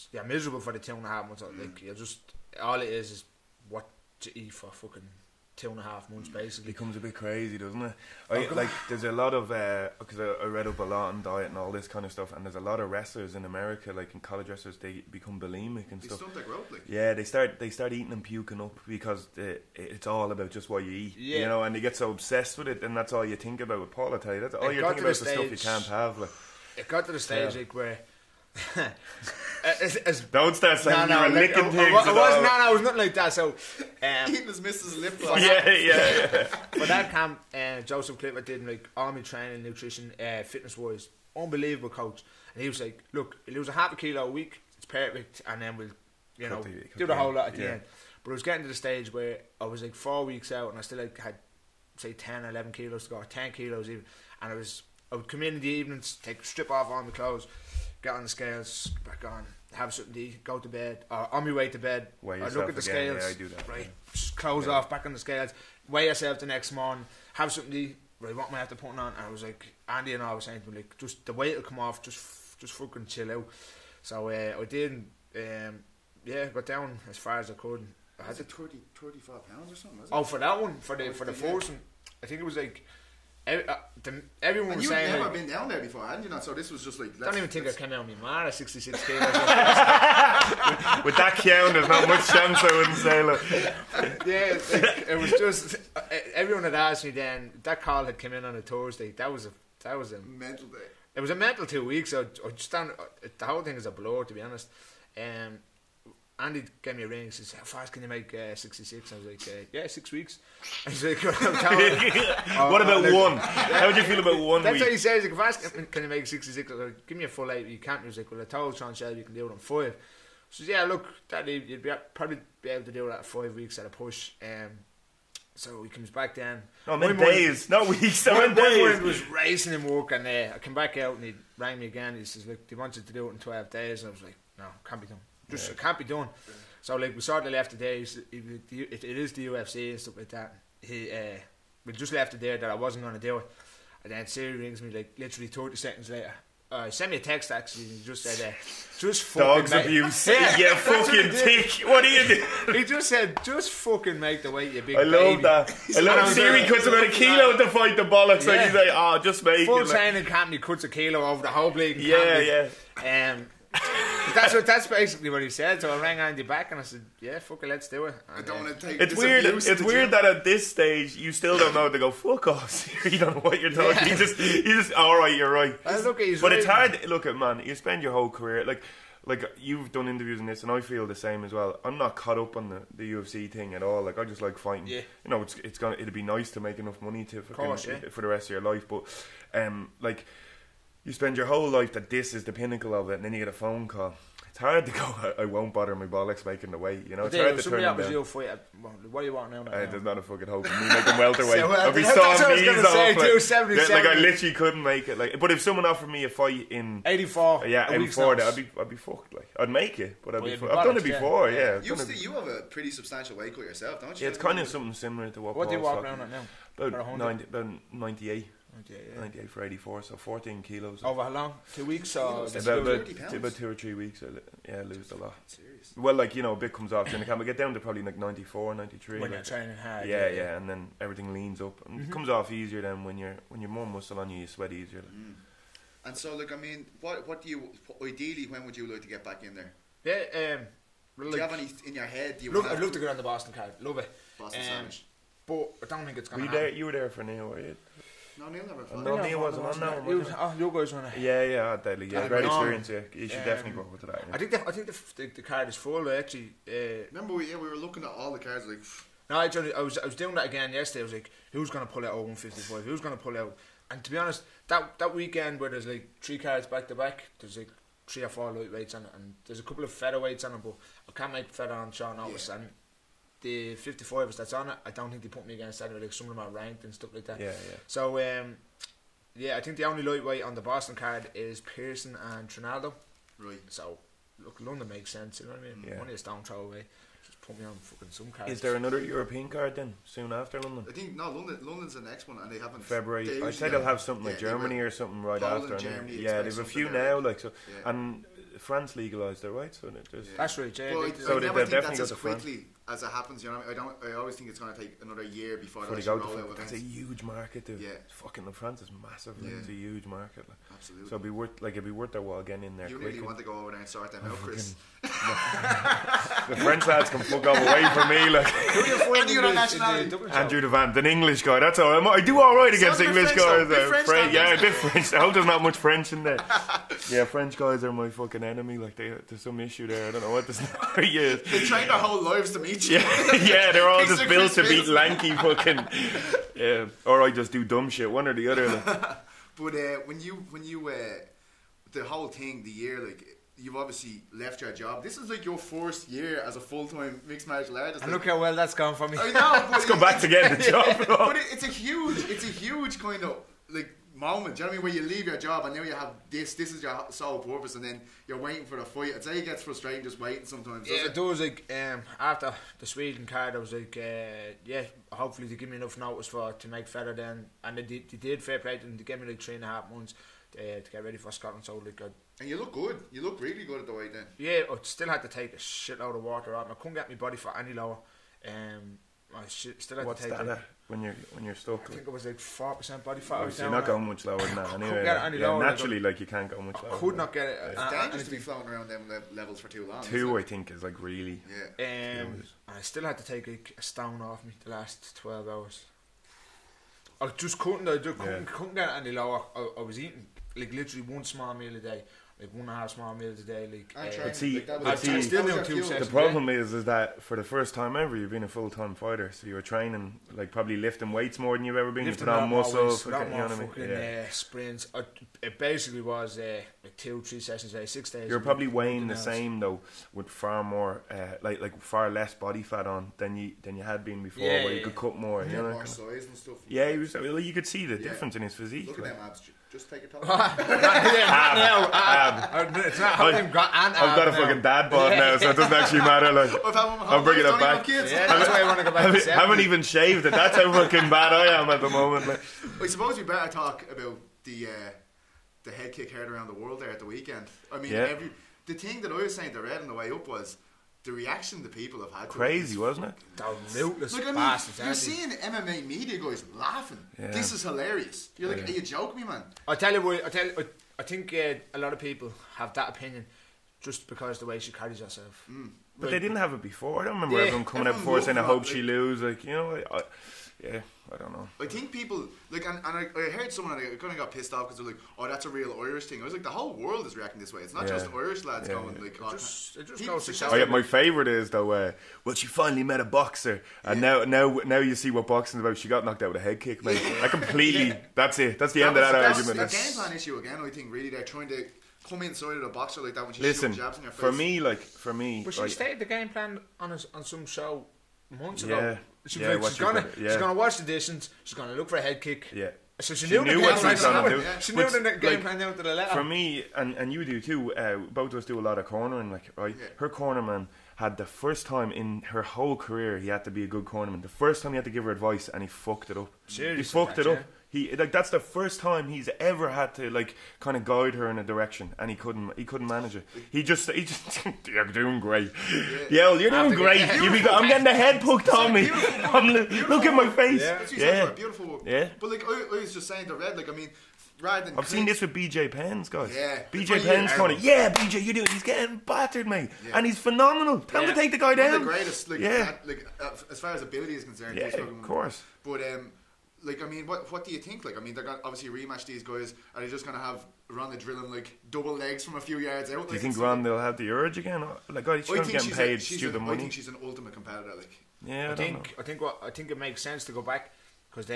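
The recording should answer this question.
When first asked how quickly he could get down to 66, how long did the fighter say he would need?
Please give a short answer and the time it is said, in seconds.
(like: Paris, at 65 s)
Six weeks, at 109 s.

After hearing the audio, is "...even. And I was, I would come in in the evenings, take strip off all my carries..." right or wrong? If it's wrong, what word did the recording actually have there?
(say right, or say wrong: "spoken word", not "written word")
wrong: "clothes", not "carries".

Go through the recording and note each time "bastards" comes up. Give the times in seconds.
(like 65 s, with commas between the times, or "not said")
454 s.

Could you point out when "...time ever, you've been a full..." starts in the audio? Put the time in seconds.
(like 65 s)
407 s.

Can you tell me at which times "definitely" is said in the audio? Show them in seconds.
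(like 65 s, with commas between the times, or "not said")
253 s, 301 s.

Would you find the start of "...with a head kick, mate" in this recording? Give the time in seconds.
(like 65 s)
486 s.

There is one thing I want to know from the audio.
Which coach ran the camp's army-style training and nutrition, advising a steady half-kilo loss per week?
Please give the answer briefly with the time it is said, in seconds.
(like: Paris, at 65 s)
Joseph Clipper, at 37 s.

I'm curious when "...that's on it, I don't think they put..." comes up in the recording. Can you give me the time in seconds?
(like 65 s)
274 s.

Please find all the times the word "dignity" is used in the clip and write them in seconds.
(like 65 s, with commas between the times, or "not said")
not said.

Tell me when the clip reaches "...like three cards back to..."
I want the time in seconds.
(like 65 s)
265 s.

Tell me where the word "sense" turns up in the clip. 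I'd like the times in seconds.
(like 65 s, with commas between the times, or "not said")
285 s, 560 s.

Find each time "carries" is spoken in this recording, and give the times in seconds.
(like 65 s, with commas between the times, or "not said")
464 s.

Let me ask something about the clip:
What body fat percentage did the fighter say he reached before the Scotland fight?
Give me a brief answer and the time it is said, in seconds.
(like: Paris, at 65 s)
4 percent, at 382 s.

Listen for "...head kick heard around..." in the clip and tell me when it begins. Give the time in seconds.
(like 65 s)
445 s.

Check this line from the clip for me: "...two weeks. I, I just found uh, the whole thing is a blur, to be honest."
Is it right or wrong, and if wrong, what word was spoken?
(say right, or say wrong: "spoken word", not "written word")
right.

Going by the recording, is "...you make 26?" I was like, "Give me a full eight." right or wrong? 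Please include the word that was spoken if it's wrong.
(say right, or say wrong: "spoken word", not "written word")
wrong: "66", not "26".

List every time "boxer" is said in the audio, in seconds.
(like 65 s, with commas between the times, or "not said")
483 s, 492 s.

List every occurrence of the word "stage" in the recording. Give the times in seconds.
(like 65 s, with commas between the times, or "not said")
27 s, 48 s, 170 s.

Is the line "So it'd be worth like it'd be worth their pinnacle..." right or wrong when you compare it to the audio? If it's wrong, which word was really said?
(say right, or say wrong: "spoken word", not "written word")
wrong: "while", not "pinnacle".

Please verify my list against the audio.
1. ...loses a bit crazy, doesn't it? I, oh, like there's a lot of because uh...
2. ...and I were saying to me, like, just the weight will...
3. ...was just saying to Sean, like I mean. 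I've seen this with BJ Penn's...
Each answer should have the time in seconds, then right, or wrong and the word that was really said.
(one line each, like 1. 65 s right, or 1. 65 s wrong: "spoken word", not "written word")
1. 6 s wrong: "becomes", not "loses"
2. 70 s right
3. 532 s wrong: "Red", not "Sean".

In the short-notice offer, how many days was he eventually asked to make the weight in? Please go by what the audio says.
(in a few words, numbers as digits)
12 days.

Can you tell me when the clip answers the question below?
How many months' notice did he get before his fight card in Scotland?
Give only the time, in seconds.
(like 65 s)
369 s.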